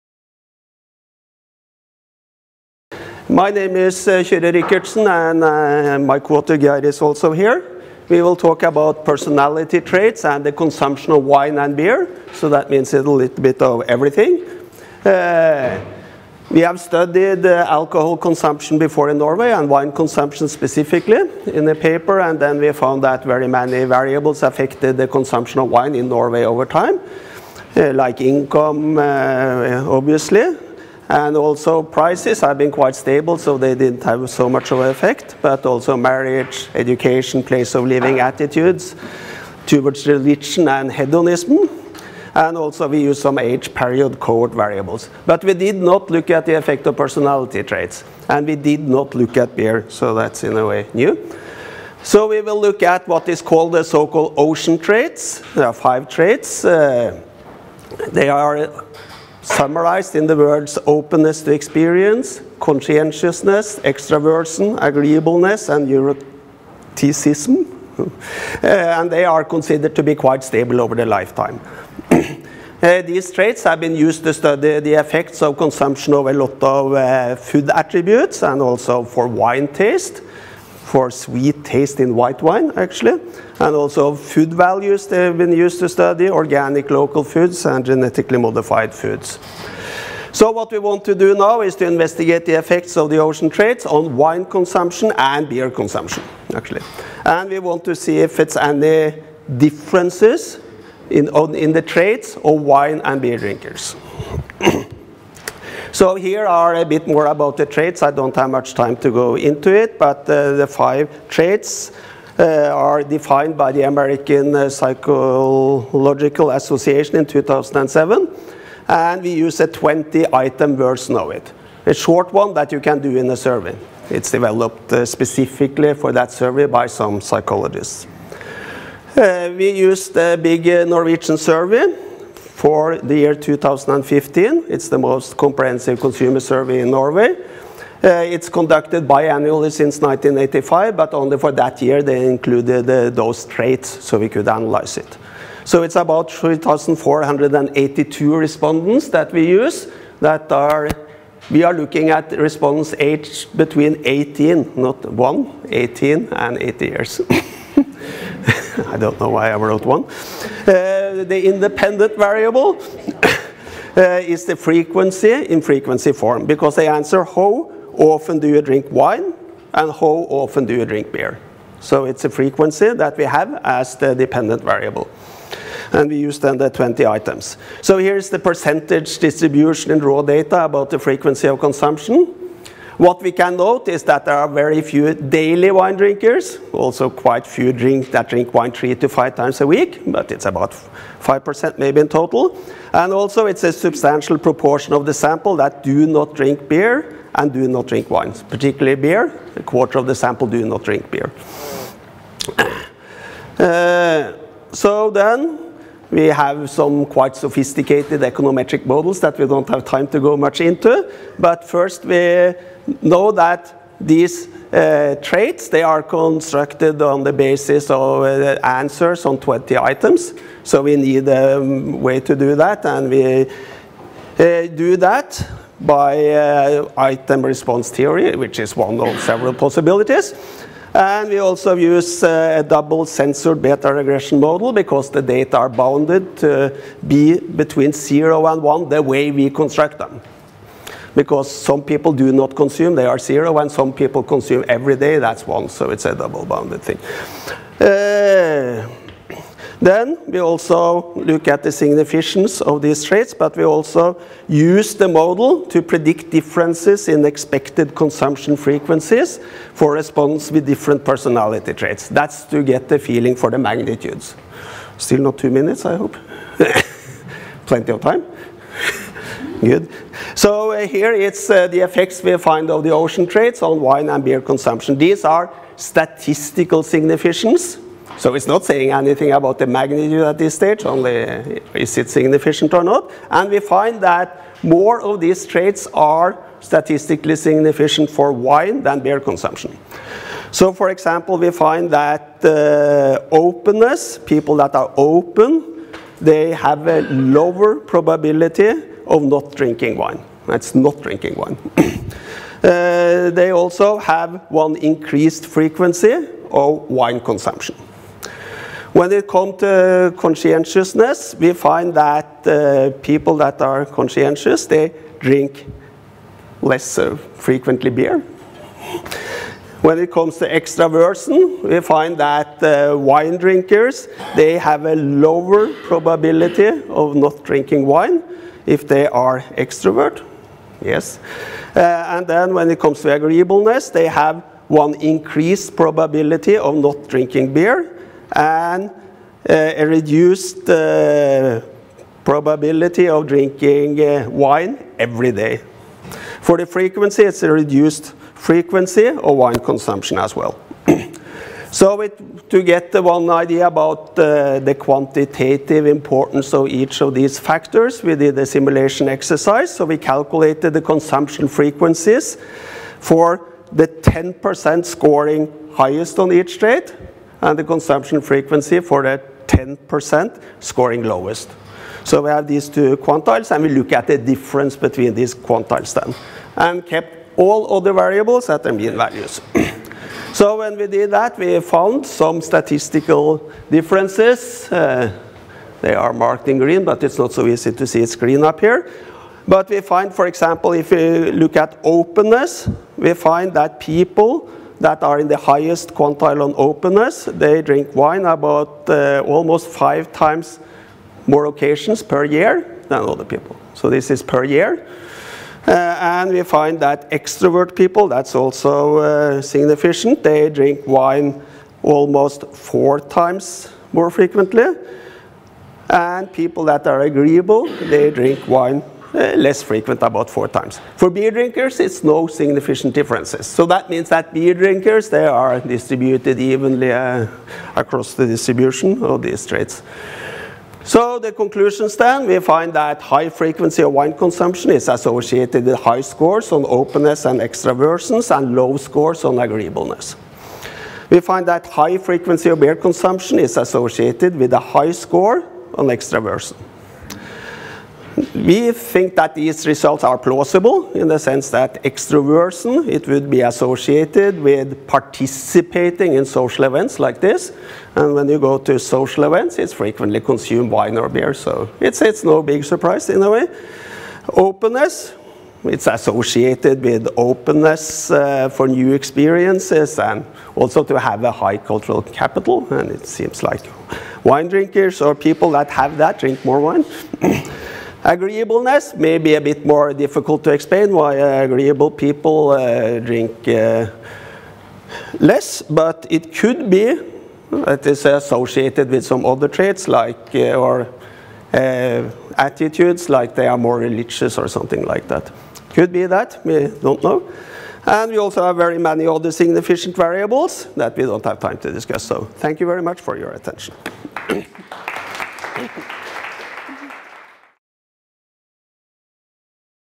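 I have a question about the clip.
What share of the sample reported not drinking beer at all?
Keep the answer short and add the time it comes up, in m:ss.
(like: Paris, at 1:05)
A quarter, at 3:19.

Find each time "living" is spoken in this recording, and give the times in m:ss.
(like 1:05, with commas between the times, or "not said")
0:37.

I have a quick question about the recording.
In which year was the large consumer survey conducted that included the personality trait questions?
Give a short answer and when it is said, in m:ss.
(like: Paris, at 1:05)
2015, at 2:13.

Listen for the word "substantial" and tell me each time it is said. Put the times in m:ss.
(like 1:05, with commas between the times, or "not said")
3:13.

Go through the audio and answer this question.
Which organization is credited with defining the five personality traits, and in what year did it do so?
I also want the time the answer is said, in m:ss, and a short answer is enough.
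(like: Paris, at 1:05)
American Psychological Association, 2007, at 1:53.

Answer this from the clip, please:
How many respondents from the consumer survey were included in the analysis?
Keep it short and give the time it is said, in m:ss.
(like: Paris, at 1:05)
3,482, at 2:26.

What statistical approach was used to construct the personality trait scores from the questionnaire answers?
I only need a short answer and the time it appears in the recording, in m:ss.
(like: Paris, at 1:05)
Item response theory, at 3:46.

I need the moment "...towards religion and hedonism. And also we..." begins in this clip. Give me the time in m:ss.
0:39.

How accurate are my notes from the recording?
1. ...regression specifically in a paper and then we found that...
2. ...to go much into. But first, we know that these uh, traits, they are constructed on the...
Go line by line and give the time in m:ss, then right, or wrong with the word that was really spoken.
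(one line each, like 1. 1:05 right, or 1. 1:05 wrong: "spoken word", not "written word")
1. 0:19 wrong: "consumption", not "regression"
2. 3:30 right.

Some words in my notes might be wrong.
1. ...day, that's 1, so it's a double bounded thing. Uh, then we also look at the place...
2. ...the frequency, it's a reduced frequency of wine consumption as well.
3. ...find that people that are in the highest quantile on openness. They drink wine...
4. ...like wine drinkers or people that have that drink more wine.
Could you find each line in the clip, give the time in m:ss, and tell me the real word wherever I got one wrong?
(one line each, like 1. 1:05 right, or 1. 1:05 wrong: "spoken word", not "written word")
1. 4:04 wrong: "significance", not "place"
2. 5:46 right
3. 6:33 right
4. 7:53 right.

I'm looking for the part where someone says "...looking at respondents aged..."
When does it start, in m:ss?
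2:31.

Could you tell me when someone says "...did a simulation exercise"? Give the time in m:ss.
5:58.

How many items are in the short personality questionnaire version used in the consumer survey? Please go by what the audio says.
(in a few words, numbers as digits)
20.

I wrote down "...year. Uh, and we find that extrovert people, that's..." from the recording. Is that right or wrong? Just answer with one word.
right.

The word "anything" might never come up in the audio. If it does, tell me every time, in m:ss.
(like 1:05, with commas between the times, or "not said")
4:38.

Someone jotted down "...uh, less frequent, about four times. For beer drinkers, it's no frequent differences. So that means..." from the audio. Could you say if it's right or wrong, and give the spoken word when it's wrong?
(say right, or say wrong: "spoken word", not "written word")
wrong: "significant", not "frequent".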